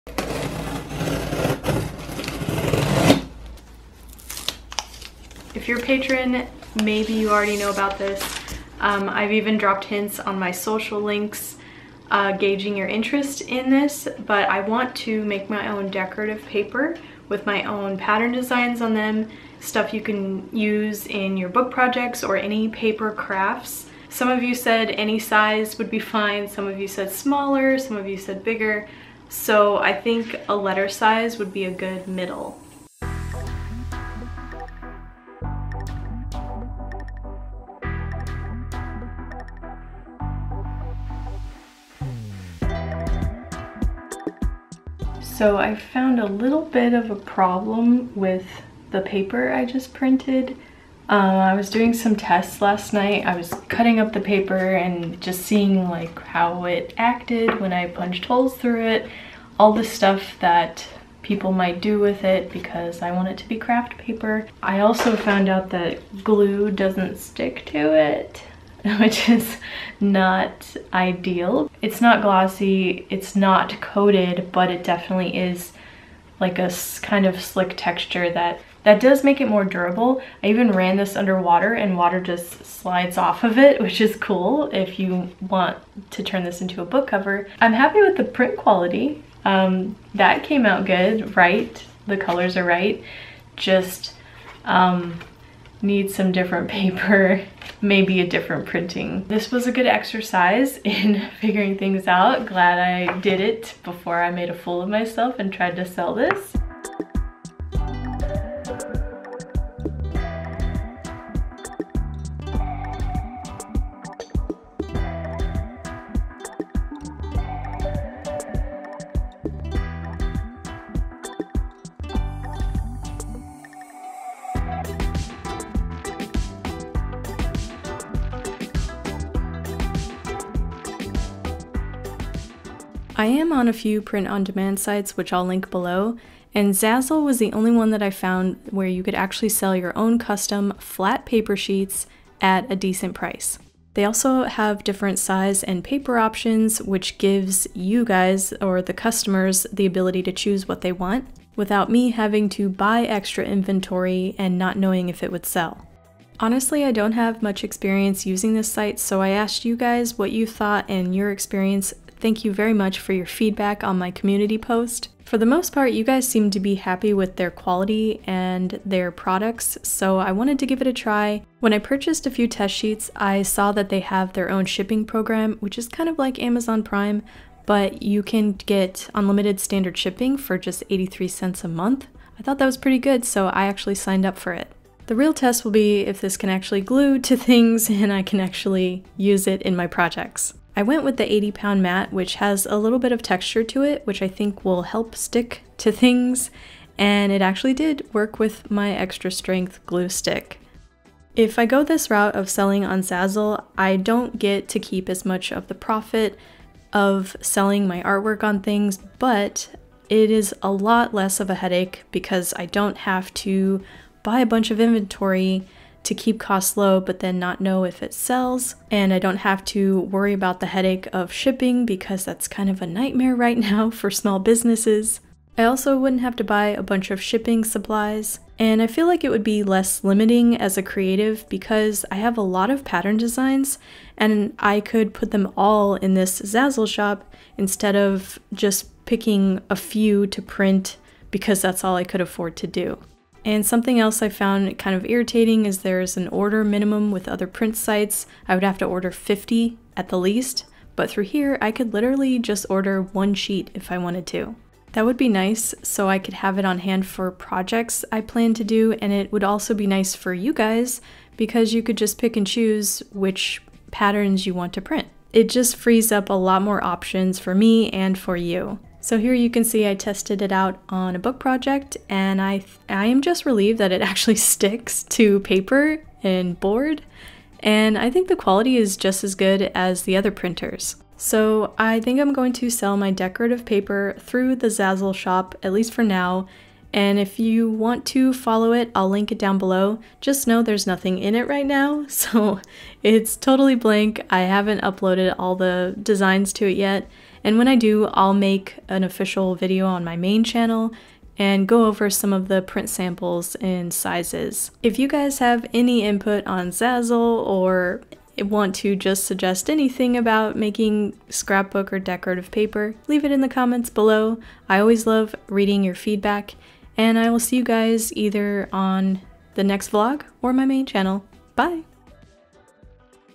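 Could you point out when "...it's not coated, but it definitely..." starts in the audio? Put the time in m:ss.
1:13.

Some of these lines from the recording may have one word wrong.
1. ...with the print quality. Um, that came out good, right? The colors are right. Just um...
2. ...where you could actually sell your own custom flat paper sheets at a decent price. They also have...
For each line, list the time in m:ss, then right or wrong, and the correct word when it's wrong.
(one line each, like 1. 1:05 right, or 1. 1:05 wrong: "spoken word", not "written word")
1. 1:27 right
2. 2:18 right.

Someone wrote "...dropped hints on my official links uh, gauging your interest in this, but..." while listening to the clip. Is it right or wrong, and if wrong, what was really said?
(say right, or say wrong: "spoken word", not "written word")
wrong: "social", not "official".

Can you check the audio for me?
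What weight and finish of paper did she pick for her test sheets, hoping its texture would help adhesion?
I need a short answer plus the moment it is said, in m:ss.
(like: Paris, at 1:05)
80 pound matte, at 3:11.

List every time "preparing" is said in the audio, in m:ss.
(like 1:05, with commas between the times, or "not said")
not said.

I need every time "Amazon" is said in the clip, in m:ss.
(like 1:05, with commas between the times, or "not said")
2:56.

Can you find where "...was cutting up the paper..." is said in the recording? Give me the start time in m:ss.
0:53.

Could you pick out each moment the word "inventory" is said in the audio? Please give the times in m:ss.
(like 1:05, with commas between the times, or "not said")
2:33, 3:34.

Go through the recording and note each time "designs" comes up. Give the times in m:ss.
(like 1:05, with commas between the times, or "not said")
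0:18, 3:53, 4:56.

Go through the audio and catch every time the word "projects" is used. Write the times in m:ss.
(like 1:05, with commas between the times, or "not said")
0:21, 3:09, 4:17, 4:31.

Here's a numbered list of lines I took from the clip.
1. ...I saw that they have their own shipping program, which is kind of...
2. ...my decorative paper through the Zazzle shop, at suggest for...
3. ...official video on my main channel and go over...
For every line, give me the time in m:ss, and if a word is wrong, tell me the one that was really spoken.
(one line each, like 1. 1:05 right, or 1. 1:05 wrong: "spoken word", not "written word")
1. 2:53 right
2. 4:42 wrong: "least", not "suggest"
3. 4:59 right.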